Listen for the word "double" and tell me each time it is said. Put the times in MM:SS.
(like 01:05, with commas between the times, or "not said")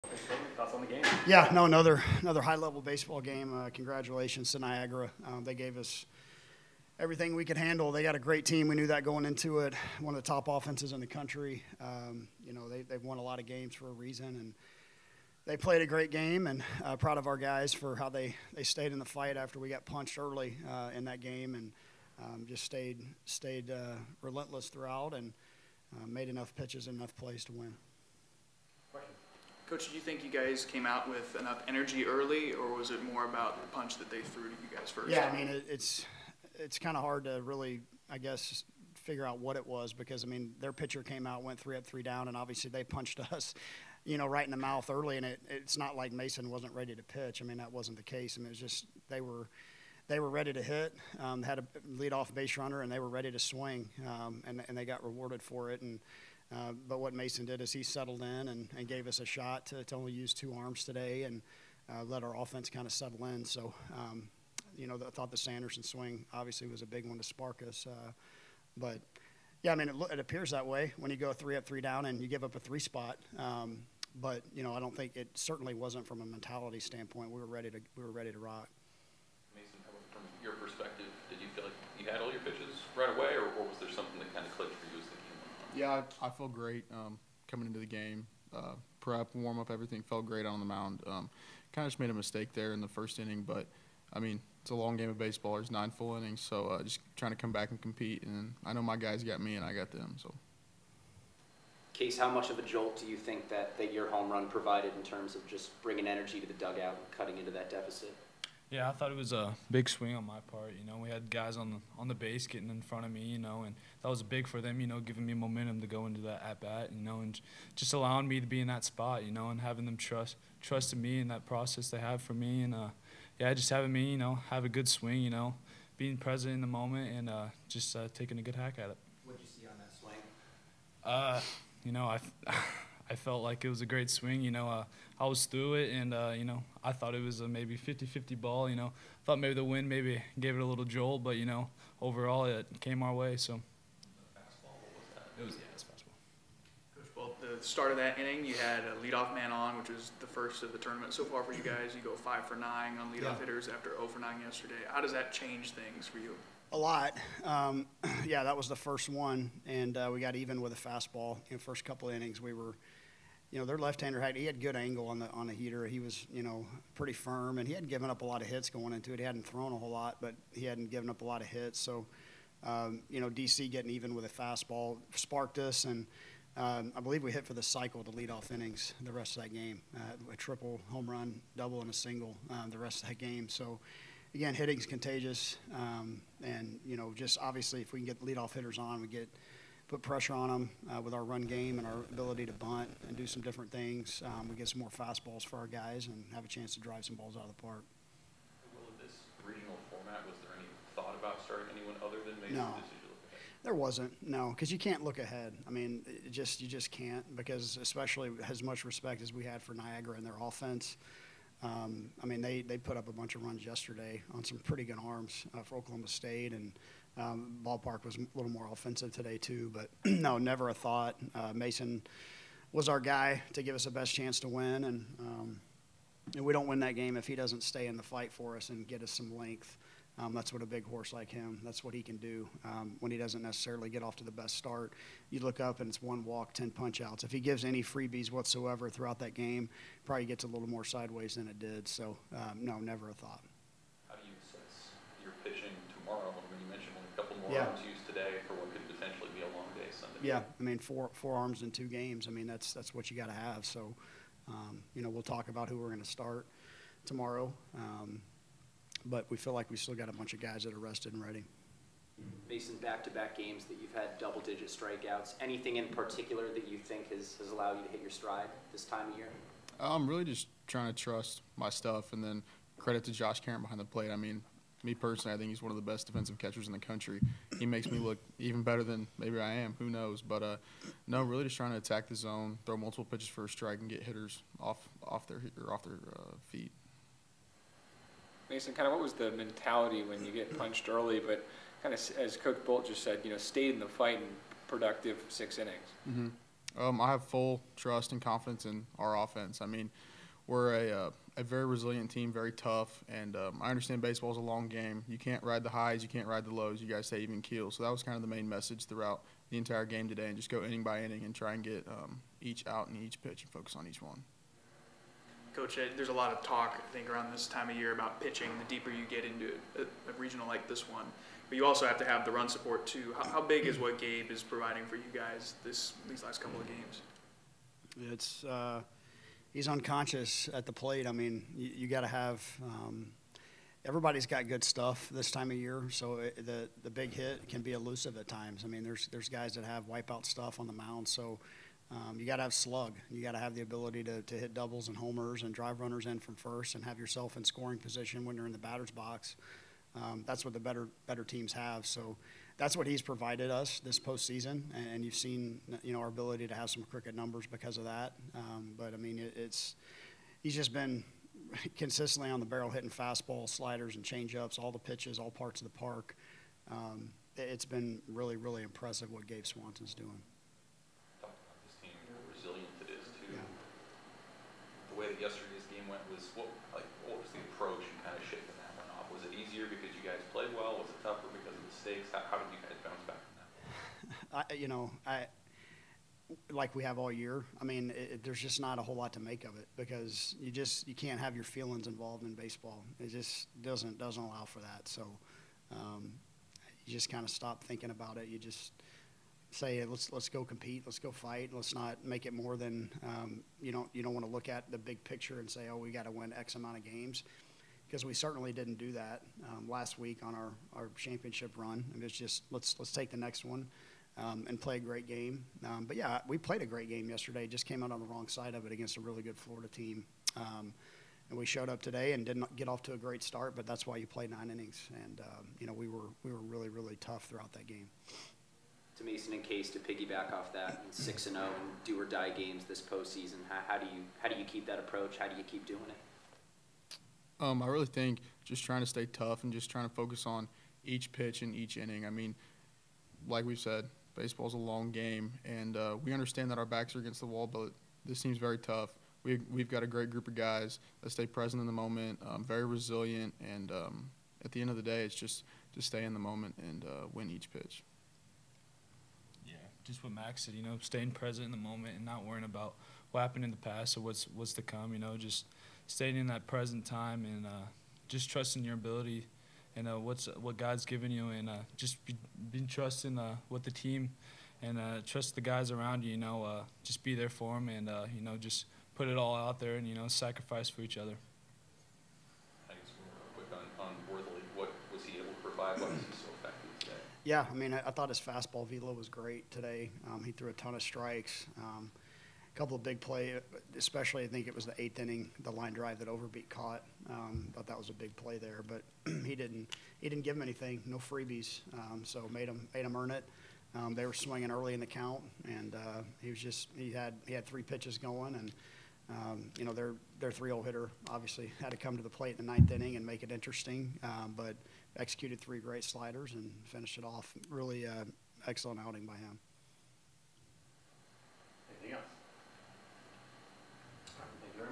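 03:01, 04:24, 05:44.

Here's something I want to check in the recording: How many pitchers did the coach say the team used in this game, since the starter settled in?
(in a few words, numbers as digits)
2.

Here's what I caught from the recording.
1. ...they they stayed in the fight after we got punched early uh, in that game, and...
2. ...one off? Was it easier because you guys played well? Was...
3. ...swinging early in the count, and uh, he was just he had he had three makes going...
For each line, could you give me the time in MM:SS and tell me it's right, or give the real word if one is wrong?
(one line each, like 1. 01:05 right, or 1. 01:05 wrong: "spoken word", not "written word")
1. 00:18 right
2. 06:18 right
3. 08:24 wrong: "pitches", not "makes".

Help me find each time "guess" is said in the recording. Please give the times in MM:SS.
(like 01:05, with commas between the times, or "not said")
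00:38, 08:02.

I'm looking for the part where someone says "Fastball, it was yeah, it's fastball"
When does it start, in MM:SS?
02:24.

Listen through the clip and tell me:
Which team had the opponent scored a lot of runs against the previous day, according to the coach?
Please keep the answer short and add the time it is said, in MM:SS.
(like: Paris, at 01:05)
Oklahoma State, at 03:35.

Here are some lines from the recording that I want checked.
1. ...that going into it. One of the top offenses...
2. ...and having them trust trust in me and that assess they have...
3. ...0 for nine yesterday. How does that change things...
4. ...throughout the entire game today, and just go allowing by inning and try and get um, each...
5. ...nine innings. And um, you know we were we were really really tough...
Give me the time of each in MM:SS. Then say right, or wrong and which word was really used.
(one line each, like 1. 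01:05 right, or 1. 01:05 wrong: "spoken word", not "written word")
1. 00:08 right
2. 01:59 wrong: "process", not "assess"
3. 02:33 right
4. 05:08 wrong: "inning", not "allowing"
5. 07:04 right.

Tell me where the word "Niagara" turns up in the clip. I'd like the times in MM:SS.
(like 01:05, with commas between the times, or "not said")
00:04, 03:29.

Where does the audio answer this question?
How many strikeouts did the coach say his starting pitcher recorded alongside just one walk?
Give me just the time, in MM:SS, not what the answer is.
03:56.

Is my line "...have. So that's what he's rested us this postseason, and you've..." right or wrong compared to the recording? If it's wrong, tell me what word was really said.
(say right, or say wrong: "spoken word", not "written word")
wrong: "provided", not "rested".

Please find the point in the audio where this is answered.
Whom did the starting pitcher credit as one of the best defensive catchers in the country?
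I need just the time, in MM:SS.
04:33.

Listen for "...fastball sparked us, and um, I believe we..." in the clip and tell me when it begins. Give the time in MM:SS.
02:54.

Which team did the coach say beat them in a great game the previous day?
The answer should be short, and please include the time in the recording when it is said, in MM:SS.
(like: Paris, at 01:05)
Florida, at 06:59.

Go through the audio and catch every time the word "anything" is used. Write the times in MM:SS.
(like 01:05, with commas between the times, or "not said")
04:25, 08:20.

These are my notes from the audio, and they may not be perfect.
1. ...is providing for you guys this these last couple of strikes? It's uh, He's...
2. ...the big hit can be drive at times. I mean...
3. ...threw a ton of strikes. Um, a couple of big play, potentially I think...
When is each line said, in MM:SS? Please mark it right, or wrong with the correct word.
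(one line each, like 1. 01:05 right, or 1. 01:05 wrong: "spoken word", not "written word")
1. 05:24 wrong: "games", not "strikes"
2. 05:36 wrong: "elusive", not "drive"
3. 08:10 wrong: "especially", not "potentially".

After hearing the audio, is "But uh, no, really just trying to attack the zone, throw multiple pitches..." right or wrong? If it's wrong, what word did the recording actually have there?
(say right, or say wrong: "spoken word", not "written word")
right.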